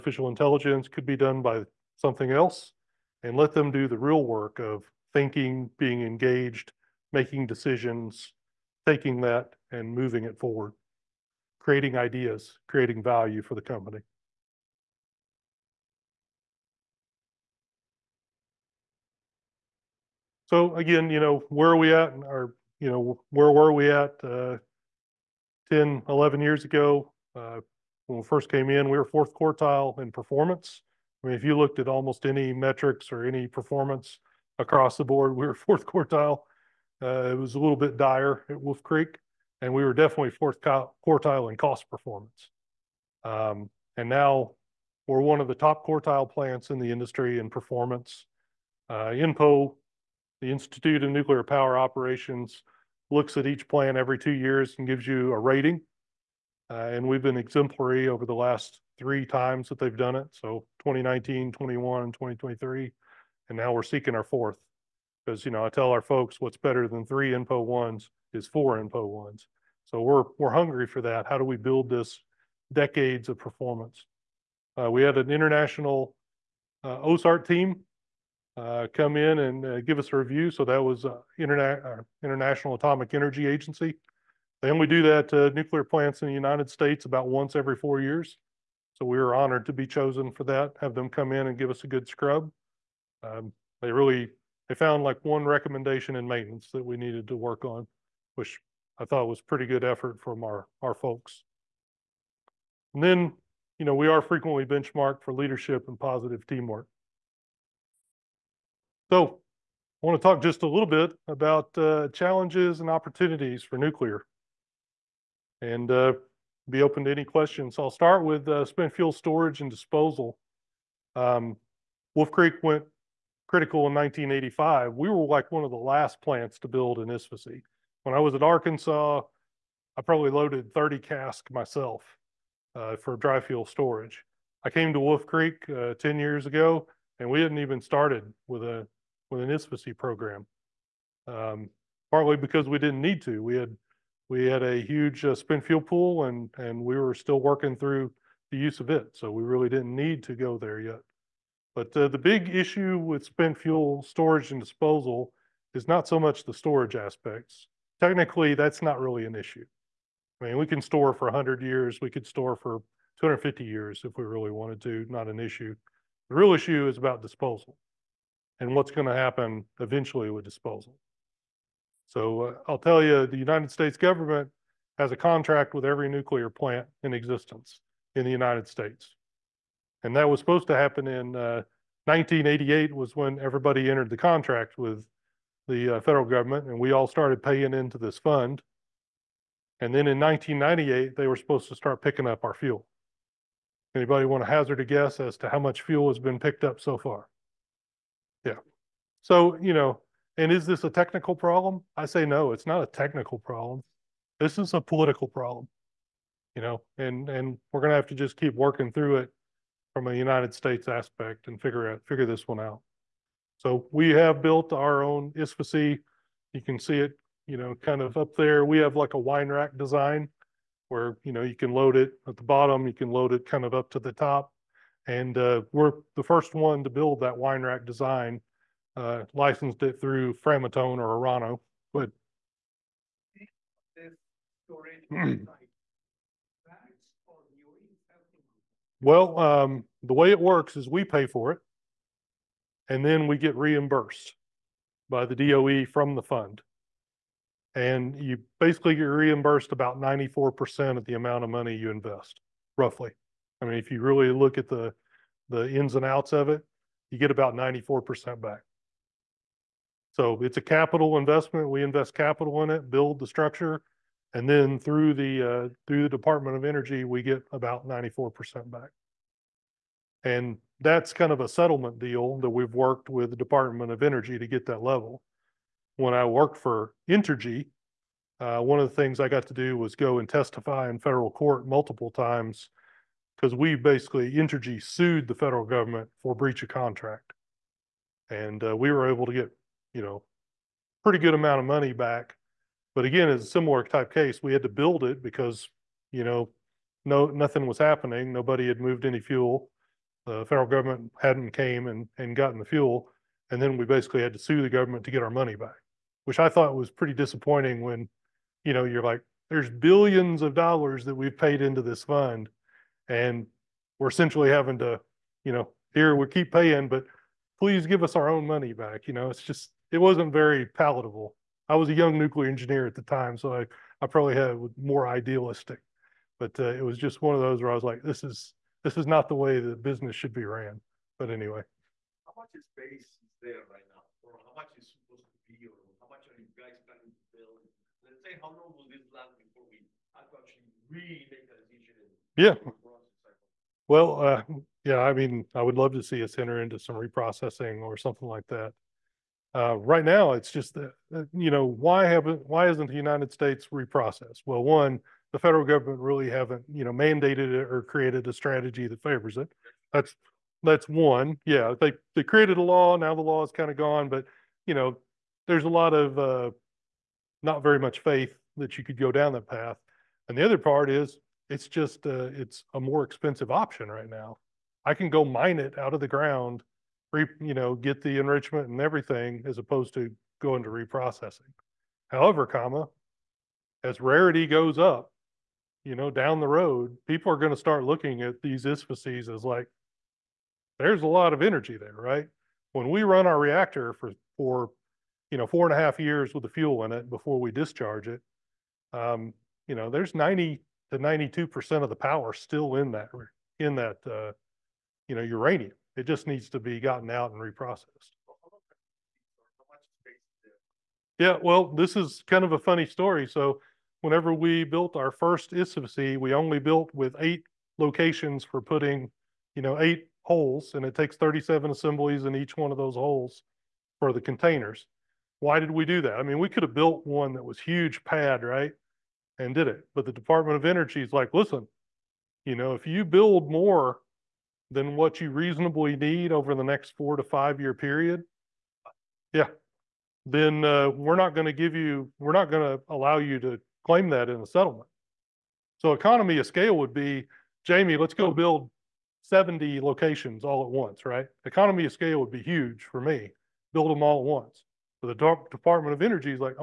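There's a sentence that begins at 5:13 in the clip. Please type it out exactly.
And we're essentially having to, you know, here we keep paying, but please give us our own money back.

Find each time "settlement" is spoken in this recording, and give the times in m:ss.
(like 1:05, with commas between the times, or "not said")
4:31, 7:24.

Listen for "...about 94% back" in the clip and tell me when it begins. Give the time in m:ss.
4:17.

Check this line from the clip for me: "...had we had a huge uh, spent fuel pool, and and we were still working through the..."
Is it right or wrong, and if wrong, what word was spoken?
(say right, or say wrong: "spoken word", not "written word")
right.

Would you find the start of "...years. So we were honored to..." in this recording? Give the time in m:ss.
1:28.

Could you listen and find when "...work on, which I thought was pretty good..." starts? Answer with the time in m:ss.
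1:37.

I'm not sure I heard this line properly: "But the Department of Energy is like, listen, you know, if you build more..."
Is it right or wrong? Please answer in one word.
right.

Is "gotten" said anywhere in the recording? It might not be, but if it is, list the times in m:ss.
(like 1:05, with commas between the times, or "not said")
5:02, 6:46.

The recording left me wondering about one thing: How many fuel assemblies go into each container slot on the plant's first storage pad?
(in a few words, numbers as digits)
37.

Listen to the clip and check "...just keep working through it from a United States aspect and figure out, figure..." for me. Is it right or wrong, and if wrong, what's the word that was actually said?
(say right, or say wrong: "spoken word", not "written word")
right.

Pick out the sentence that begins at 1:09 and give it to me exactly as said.
So we're, we're hungry for that.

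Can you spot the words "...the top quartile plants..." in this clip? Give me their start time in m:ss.
0:45.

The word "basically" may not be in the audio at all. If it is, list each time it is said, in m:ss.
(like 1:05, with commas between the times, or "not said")
4:08, 4:43, 5:03.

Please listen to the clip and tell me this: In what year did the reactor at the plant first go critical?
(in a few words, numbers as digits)
1985.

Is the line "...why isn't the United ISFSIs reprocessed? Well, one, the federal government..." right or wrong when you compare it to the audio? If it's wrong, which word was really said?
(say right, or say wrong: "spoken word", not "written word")
wrong: "States", not "ISFSIs".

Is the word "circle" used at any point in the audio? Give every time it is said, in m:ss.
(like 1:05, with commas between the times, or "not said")
not said.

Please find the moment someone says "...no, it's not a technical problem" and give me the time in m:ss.
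3:22.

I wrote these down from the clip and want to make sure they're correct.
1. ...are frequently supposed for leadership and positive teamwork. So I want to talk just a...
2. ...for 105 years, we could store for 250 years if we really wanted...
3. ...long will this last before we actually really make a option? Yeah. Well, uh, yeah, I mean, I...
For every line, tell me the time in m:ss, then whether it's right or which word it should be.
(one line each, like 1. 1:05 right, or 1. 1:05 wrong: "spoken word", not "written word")
1. 1:44 wrong: "benchmarked", not "supposed"
2. 2:41 wrong: "100", not "105"
3. 5:38 wrong: "decision", not "option".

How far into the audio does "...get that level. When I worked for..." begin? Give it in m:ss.
4:34.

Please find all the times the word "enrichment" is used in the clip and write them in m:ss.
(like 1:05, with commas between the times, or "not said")
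6:18.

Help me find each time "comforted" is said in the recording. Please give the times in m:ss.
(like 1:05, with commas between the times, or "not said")
not said.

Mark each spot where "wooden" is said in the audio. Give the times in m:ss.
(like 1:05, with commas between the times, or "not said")
not said.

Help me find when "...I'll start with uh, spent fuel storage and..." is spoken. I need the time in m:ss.
1:57.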